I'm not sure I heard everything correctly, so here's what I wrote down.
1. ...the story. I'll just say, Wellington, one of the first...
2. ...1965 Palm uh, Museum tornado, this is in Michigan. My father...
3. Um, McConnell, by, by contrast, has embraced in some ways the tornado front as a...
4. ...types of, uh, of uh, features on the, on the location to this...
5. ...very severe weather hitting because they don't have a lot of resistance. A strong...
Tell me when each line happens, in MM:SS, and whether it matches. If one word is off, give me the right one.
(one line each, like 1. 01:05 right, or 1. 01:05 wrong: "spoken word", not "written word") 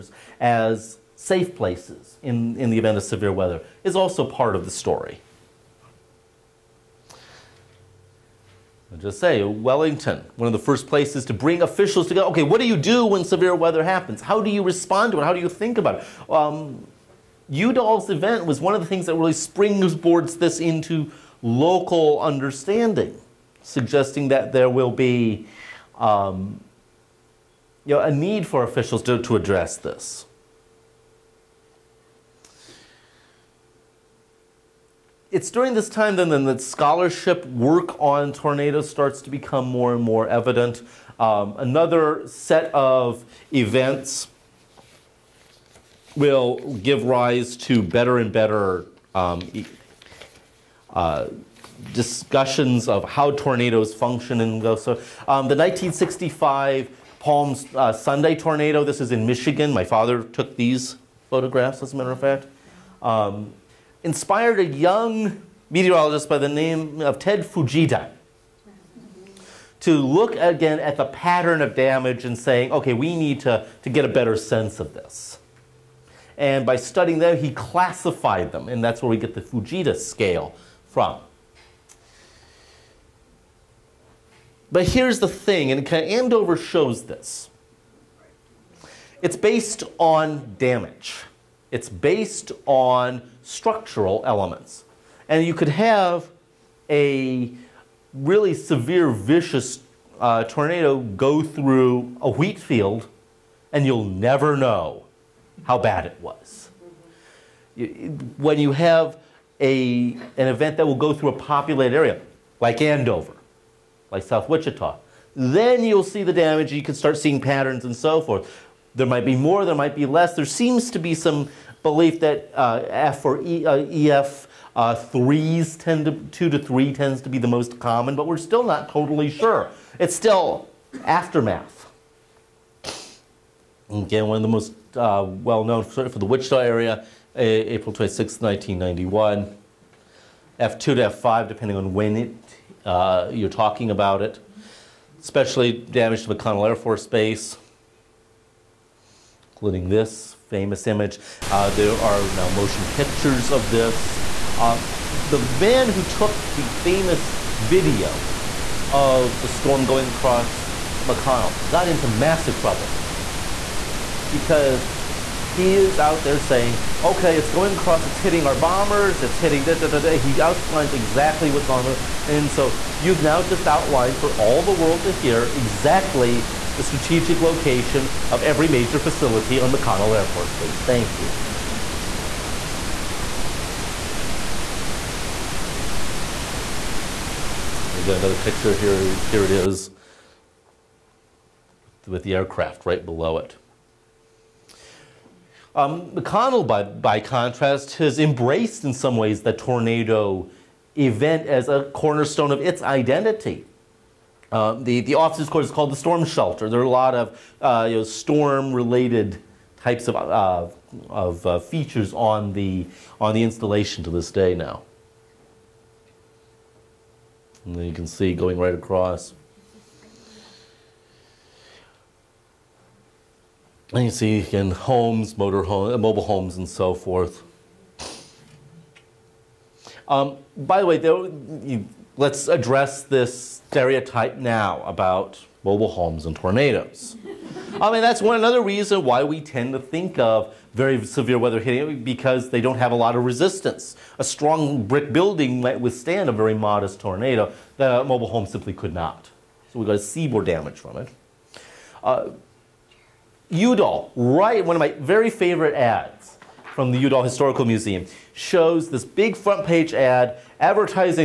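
1. 00:04 right
2. 00:55 wrong: "Sunday", not "Museum"
3. 03:15 wrong: "event", not "front"
4. 03:29 wrong: "installation", not "location"
5. 04:00 right.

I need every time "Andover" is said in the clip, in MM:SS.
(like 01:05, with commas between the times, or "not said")
01:25, 01:52.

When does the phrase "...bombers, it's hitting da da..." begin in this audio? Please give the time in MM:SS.
02:48.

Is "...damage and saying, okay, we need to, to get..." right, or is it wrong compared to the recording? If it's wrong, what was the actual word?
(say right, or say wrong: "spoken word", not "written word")
right.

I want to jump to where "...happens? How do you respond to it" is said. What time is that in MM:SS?
00:13.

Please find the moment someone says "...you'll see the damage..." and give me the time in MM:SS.
01:55.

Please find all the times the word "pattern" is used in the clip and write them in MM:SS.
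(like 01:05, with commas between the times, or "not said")
01:11, 01:57.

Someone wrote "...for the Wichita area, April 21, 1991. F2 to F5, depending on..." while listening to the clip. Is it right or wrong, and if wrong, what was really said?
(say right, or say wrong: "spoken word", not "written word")
wrong: "26", not "21".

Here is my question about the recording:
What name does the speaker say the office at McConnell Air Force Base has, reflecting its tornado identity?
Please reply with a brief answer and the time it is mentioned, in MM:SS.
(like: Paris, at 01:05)
the storm shelter, at 03:25.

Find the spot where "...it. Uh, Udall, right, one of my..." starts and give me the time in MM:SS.
04:10.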